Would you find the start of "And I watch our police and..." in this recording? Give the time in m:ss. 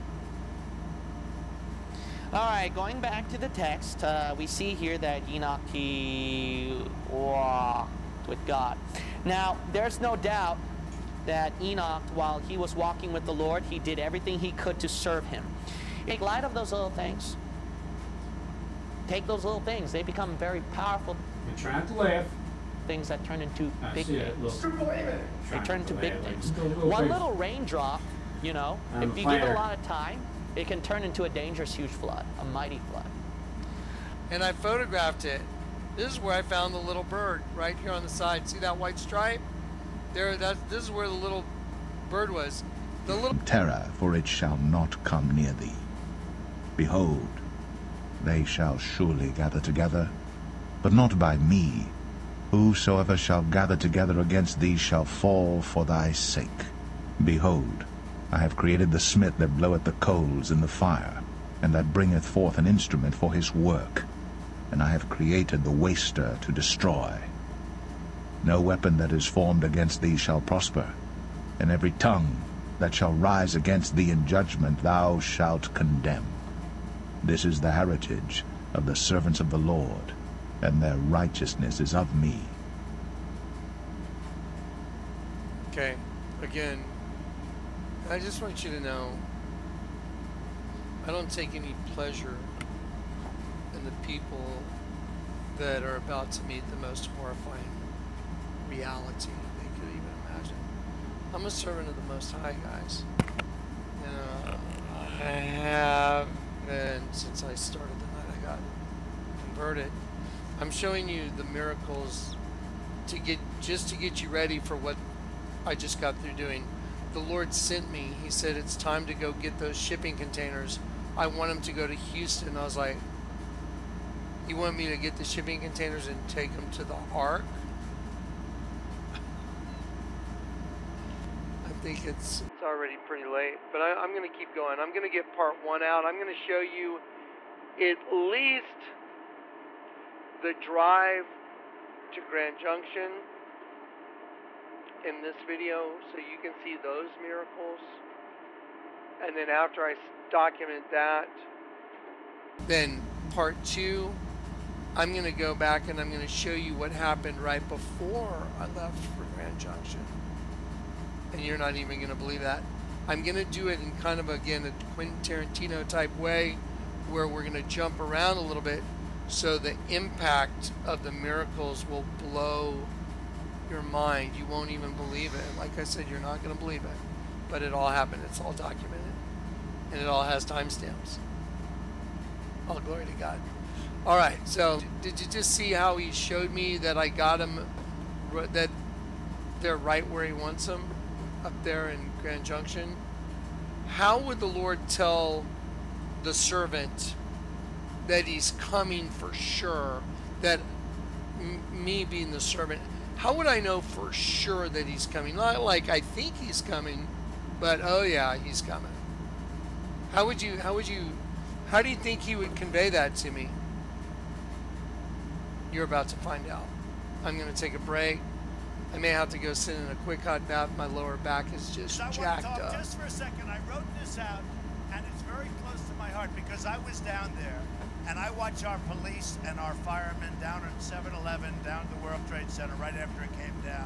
3:48.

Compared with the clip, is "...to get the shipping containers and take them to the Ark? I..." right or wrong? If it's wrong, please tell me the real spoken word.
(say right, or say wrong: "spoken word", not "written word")
right.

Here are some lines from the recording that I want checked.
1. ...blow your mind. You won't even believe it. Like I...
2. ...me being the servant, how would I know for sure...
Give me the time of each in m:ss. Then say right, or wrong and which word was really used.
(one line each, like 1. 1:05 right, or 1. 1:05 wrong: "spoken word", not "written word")
1. 2:52 right
2. 3:21 right.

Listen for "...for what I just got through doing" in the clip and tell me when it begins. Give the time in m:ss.
1:54.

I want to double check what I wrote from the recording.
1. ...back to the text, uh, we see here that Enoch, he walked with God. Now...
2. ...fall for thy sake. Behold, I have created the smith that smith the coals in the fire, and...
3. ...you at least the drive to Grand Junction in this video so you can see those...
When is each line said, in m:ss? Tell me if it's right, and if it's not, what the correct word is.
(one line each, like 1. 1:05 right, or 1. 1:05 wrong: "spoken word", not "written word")
1. 0:03 right
2. 0:55 wrong: "bloweth", not "smith"
3. 2:16 right.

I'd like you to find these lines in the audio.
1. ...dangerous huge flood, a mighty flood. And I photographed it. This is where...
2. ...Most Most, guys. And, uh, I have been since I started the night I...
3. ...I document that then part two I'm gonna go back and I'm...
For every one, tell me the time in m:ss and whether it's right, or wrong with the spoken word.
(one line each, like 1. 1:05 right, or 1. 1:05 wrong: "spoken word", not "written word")
1. 0:31 right
2. 1:42 wrong: "High", not "Most"
3. 2:29 right.